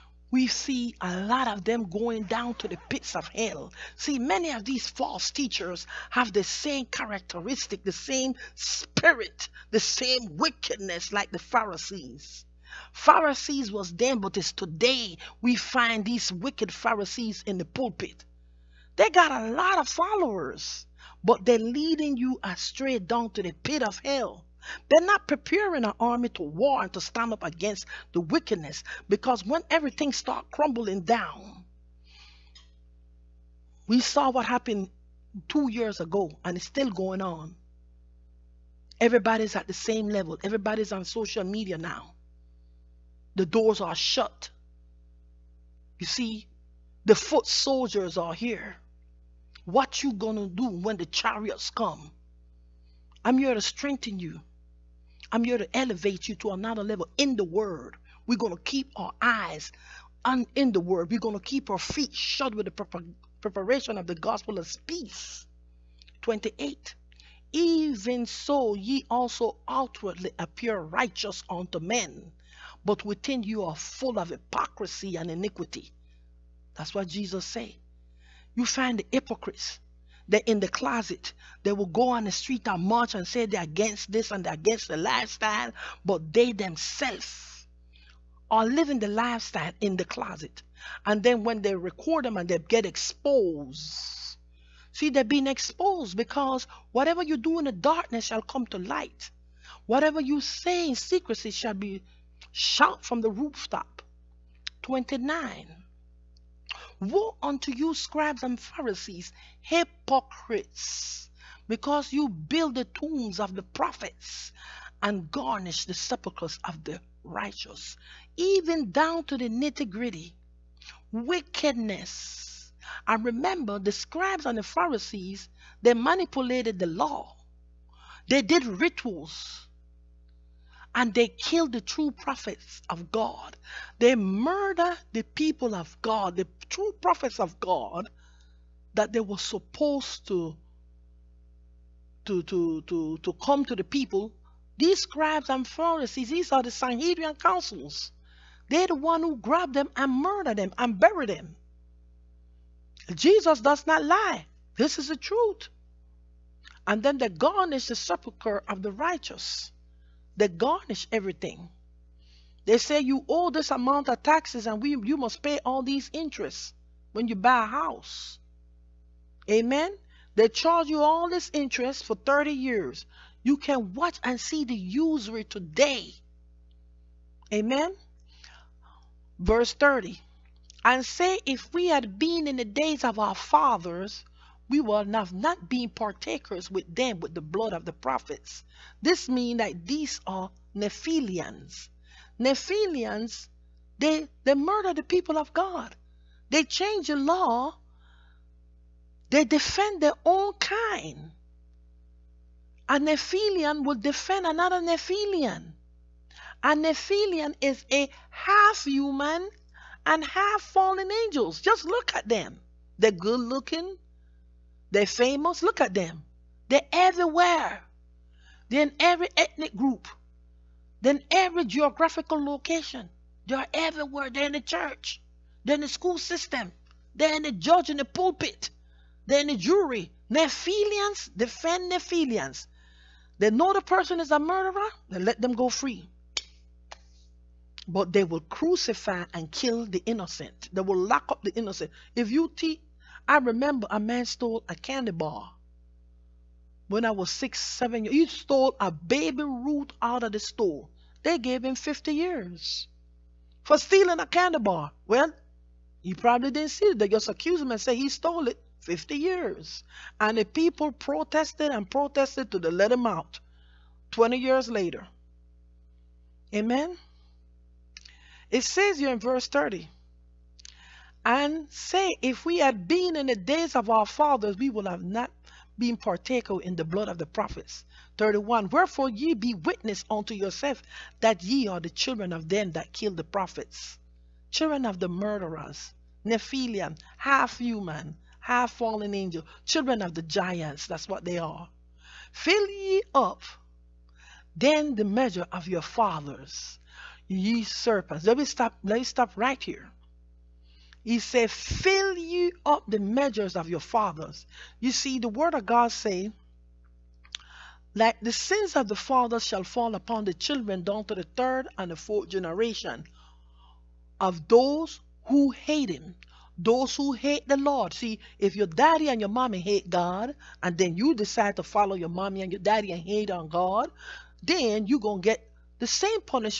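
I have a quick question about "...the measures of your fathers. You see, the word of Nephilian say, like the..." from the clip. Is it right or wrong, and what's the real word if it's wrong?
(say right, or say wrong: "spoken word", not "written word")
wrong: "God", not "Nephilian".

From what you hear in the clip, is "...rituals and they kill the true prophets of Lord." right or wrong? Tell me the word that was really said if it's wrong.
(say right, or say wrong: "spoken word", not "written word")
wrong: "God", not "Lord".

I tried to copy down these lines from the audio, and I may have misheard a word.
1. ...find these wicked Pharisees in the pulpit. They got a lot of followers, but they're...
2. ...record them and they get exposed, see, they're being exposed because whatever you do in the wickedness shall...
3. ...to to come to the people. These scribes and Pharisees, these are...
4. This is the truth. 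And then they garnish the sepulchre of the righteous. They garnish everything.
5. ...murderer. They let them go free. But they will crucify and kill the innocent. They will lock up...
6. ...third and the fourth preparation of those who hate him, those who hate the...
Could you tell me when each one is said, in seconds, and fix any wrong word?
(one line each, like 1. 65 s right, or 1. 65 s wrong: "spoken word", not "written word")
1. 15 s right
2. 91 s wrong: "darkness", not "wickedness"
3. 142 s right
4. 154 s right
5. 234 s right
6. 311 s wrong: "generation", not "preparation".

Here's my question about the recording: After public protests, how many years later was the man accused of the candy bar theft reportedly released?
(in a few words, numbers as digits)
20.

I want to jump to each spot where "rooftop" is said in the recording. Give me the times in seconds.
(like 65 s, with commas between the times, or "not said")
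103 s.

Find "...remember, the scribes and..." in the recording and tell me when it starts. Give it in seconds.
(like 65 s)
123 s.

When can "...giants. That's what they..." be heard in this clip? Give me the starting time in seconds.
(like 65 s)
290 s.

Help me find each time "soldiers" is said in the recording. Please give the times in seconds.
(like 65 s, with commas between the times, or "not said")
47 s.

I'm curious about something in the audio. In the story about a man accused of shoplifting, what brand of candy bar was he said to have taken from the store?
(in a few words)
Baby Ruth.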